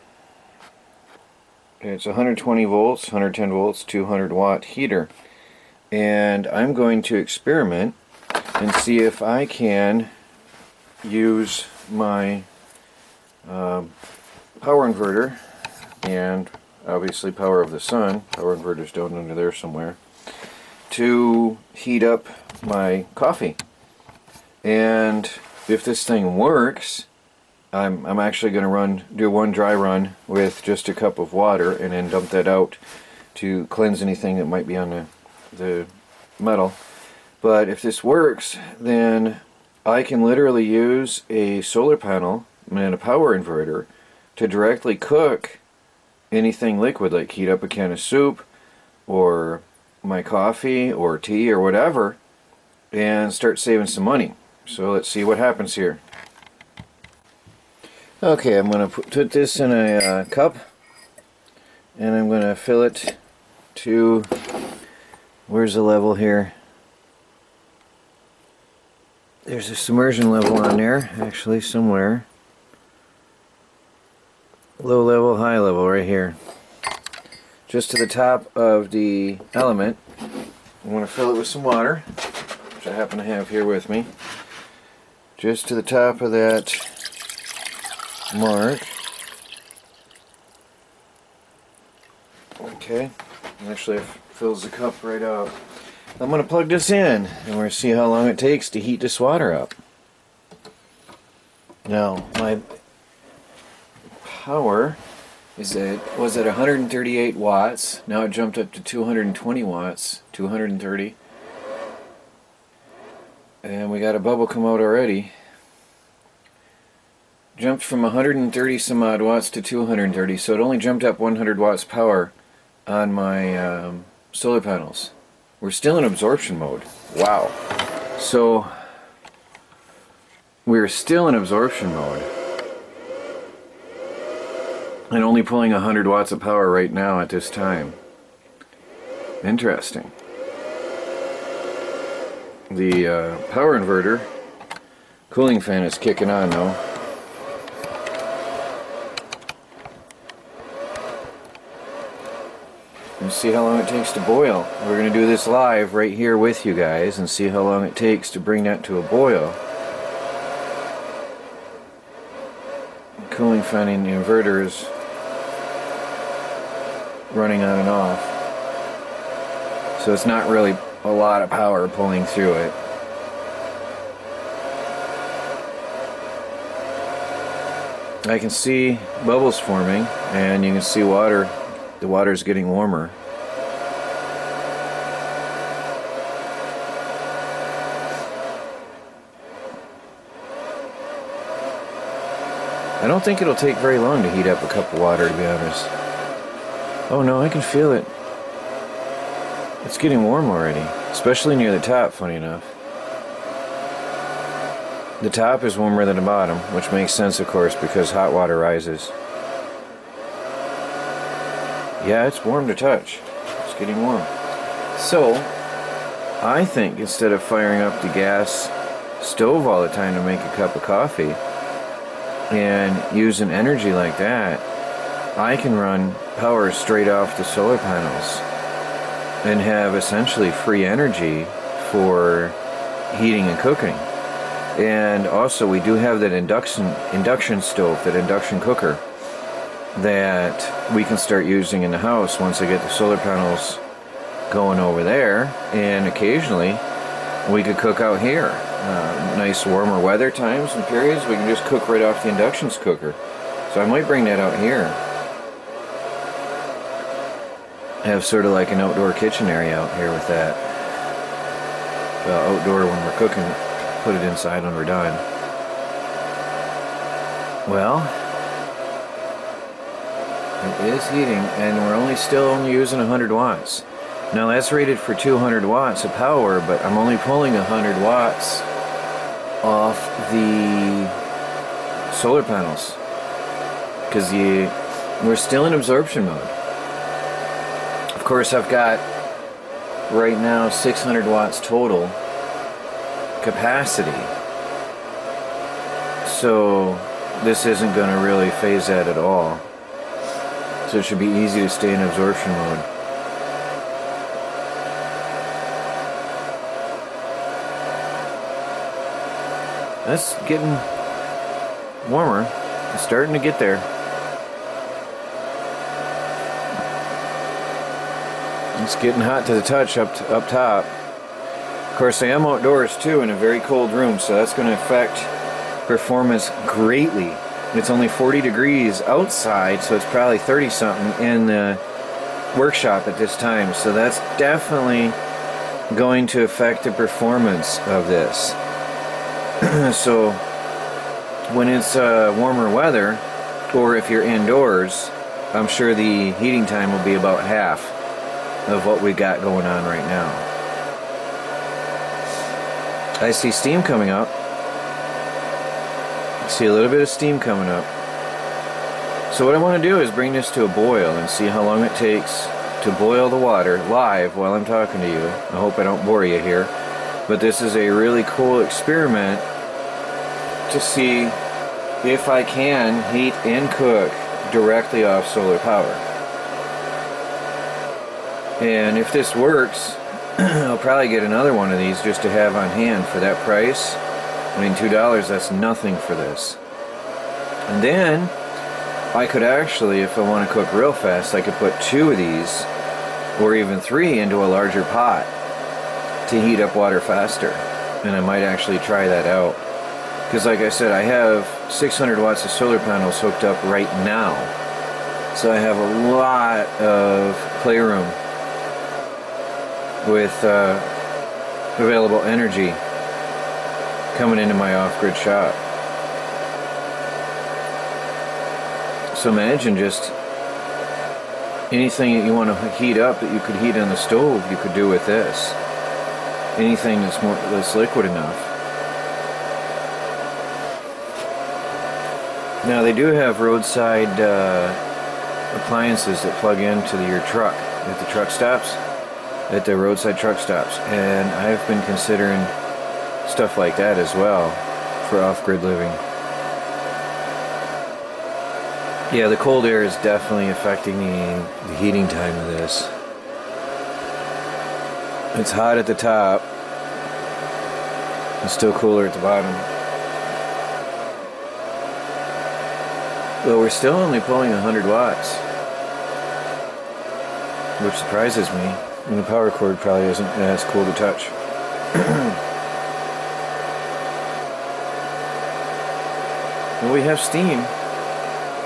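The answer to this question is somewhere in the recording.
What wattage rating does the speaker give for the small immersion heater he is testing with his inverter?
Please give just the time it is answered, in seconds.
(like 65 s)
3 s.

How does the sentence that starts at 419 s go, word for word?
So imagine just anything that you want to heat up that you could heat on the stove, you could do with this.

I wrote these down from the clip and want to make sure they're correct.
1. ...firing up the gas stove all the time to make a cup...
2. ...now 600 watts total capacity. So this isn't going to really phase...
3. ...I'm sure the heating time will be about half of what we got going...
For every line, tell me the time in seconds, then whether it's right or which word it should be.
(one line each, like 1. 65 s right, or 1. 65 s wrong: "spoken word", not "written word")
1. 217 s right
2. 290 s right
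3. 345 s right.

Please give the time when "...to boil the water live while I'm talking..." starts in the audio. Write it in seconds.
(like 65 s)
362 s.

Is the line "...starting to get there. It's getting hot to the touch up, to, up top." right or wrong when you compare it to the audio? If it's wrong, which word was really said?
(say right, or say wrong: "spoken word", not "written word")
right.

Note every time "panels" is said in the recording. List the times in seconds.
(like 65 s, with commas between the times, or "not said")
41 s, 124 s, 227 s, 243 s, 282 s, 402 s.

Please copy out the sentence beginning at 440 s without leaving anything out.
And I've been considering stuff like that as well for off grid living.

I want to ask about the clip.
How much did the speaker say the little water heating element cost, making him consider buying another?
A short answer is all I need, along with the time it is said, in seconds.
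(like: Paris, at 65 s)
$2, at 384 s.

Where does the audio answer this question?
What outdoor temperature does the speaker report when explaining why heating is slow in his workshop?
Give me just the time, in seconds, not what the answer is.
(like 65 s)
328 s.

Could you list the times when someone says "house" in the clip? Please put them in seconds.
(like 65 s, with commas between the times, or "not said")
241 s.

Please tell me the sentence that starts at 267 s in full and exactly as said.
Well, it is heating, and we're only still only using 100 watts.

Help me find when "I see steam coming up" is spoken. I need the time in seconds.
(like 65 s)
353 s.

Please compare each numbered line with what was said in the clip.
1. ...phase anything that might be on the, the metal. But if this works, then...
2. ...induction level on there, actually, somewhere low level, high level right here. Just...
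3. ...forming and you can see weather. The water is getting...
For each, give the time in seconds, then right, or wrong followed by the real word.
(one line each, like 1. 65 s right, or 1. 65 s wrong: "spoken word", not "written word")
1. 33 s wrong: "cleanse", not "phase"
2. 69 s wrong: "submersion", not "induction"
3. 179 s wrong: "water", not "weather".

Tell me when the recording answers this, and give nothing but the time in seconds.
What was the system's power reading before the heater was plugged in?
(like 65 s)
106 s.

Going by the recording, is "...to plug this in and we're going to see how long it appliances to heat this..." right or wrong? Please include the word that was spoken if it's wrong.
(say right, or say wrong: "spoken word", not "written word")
wrong: "takes", not "appliances".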